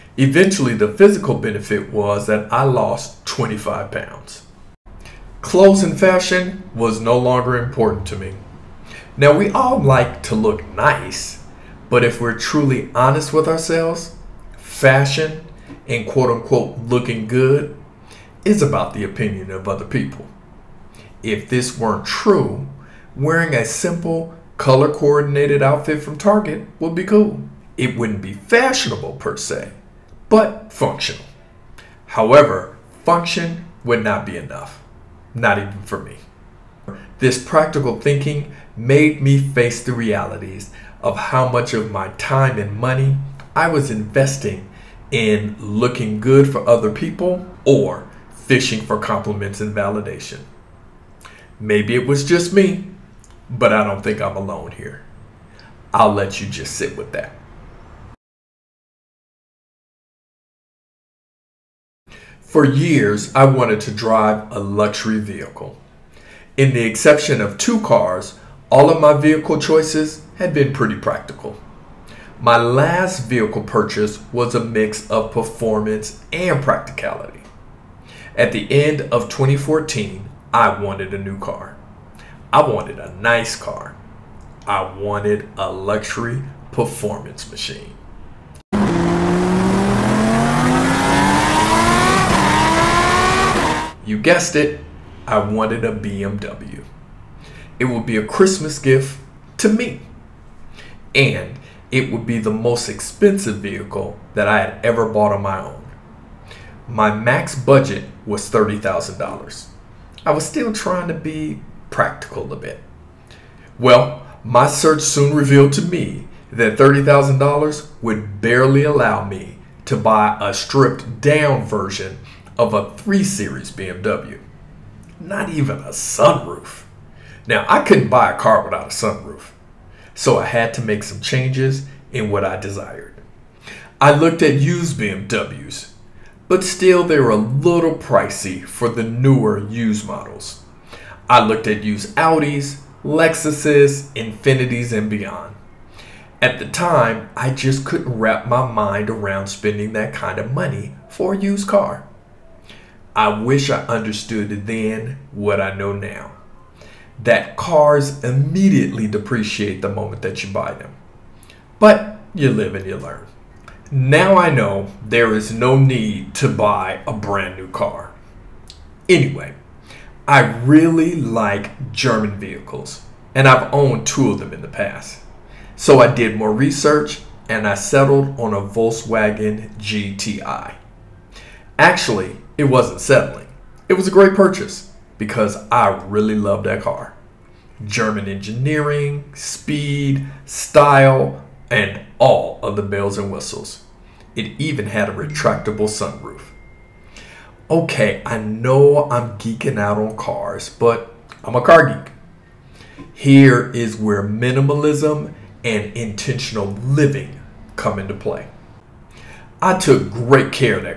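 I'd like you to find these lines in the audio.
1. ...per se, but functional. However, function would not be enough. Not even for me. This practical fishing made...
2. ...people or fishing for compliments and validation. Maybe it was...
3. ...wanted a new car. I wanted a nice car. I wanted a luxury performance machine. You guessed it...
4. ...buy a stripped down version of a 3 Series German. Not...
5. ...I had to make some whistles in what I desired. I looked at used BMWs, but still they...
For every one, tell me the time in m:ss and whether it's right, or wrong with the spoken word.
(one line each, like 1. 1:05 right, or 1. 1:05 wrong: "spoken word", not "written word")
1. 0:29 wrong: "thinking", not "fishing"
2. 0:46 right
3. 1:20 right
4. 1:59 wrong: "BMW", not "German"
5. 2:10 wrong: "changes", not "whistles".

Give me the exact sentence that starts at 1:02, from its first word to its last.
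For years, I wanted to drive a luxury vehicle.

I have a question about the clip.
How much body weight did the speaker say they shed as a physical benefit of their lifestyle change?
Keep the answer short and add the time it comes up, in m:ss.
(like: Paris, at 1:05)
25 pounds, at 0:03.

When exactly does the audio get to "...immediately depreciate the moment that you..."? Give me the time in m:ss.
2:38.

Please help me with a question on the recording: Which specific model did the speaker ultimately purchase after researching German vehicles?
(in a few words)
Volkswagen GTI.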